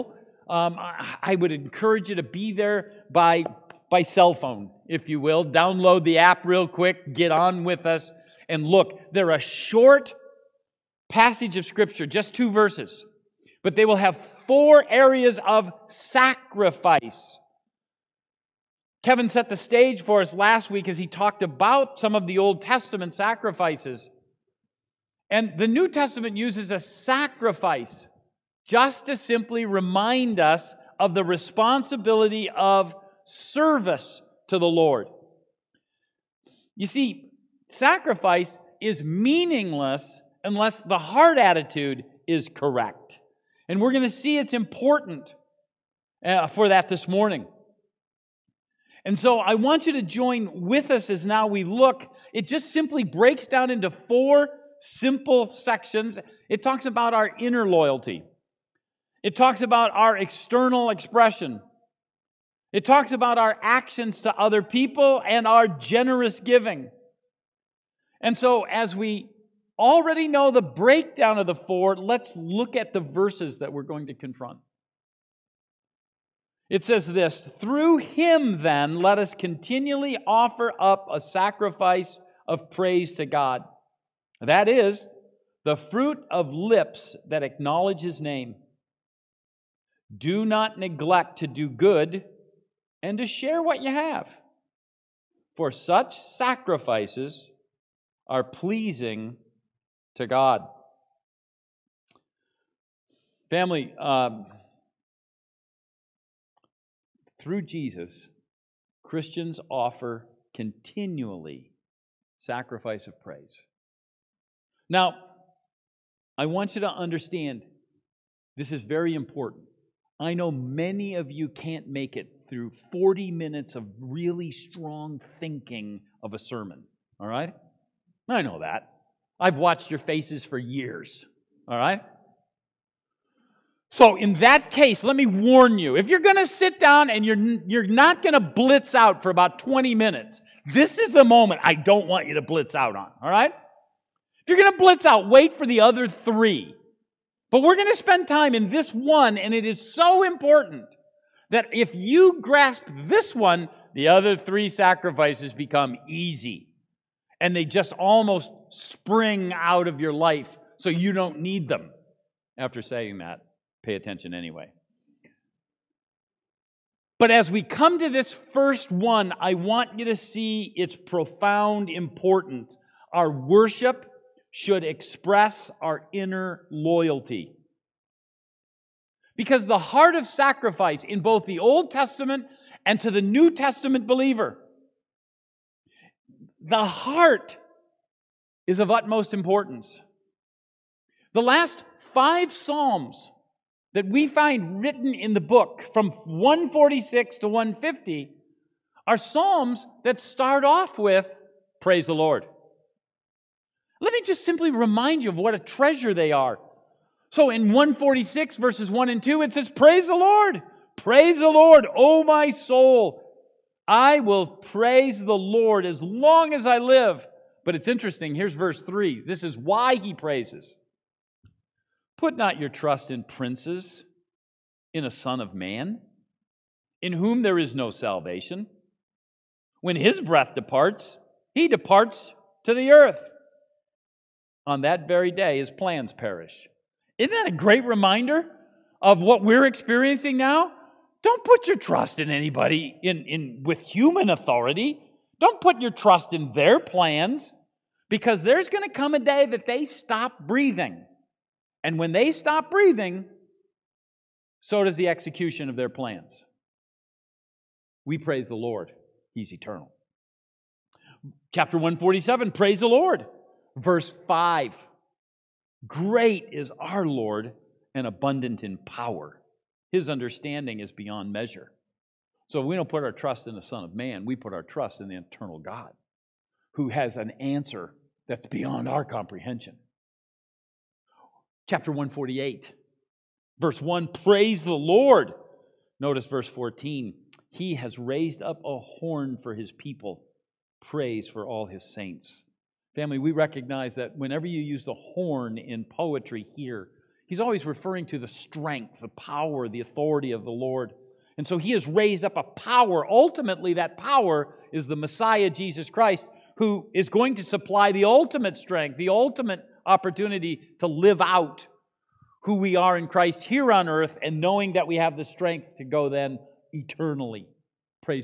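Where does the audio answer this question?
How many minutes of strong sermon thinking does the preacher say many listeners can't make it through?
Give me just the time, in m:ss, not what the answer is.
2:02.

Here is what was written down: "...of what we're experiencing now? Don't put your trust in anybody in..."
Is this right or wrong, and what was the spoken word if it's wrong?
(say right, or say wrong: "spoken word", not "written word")
right.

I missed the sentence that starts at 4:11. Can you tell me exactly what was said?
And when they stop breathing, so does the execution of their plans.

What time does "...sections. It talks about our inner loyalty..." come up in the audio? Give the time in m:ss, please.
0:55.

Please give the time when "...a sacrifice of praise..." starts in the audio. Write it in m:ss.
1:21.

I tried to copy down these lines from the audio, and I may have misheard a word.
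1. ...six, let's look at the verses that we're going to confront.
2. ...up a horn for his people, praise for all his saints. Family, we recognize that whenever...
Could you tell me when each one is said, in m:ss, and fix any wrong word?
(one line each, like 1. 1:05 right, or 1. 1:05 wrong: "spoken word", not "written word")
1. 1:11 wrong: "four", not "six"
2. 4:48 right.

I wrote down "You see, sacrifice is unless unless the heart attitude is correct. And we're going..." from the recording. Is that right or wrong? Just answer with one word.
wrong.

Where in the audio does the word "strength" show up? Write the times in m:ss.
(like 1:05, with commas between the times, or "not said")
4:58, 5:08, 5:15.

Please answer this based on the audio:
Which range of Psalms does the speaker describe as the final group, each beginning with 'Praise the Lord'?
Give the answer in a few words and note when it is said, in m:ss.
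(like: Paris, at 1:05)
146 to 150, at 3:16.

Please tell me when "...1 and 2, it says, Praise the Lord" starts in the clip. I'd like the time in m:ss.
3:28.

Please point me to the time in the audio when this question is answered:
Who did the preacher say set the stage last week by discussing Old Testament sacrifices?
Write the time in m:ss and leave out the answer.
0:19.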